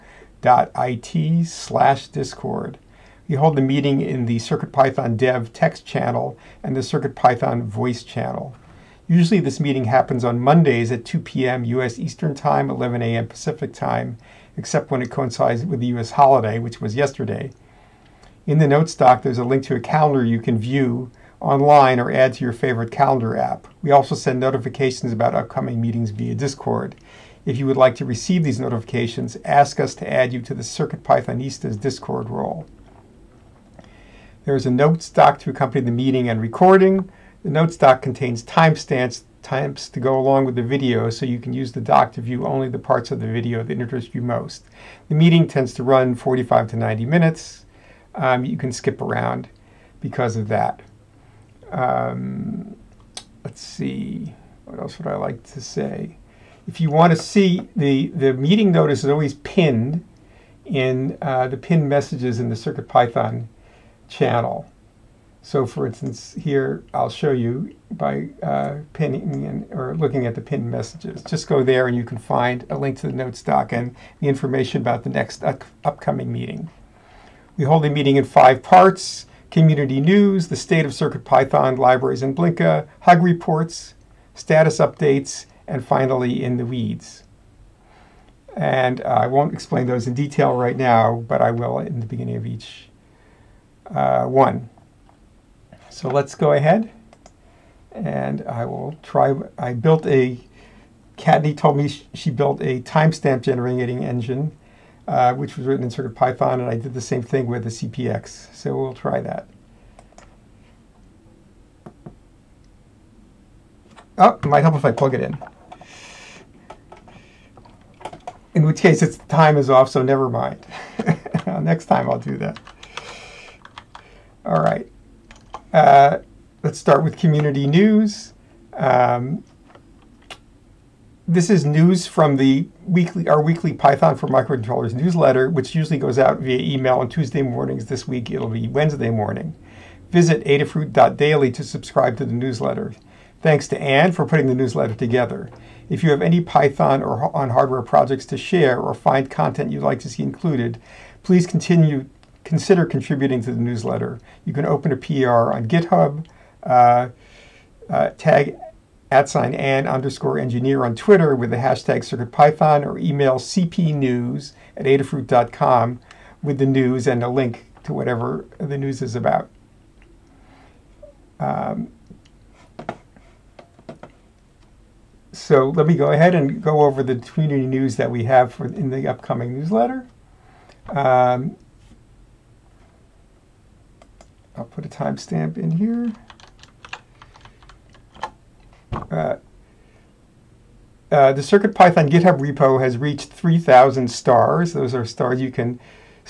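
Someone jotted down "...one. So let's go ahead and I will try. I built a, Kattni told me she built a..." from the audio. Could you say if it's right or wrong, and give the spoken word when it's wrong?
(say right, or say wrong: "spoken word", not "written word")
right.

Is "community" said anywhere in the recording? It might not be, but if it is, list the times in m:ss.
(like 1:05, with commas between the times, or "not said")
1:19, 2:07, 2:57.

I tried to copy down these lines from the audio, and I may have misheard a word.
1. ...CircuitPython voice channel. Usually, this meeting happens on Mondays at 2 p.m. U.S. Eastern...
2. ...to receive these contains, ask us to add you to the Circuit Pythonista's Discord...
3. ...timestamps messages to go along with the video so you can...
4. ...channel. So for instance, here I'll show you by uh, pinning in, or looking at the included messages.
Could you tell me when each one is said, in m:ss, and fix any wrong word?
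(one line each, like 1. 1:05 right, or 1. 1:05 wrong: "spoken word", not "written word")
1. 0:06 right
2. 0:27 wrong: "notifications", not "contains"
3. 0:38 wrong: "times", not "messages"
4. 1:04 wrong: "pinned", not "included".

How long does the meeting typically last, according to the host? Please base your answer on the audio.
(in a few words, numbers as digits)
45 to 90 minutes.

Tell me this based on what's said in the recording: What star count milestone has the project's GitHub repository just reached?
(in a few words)
3,000.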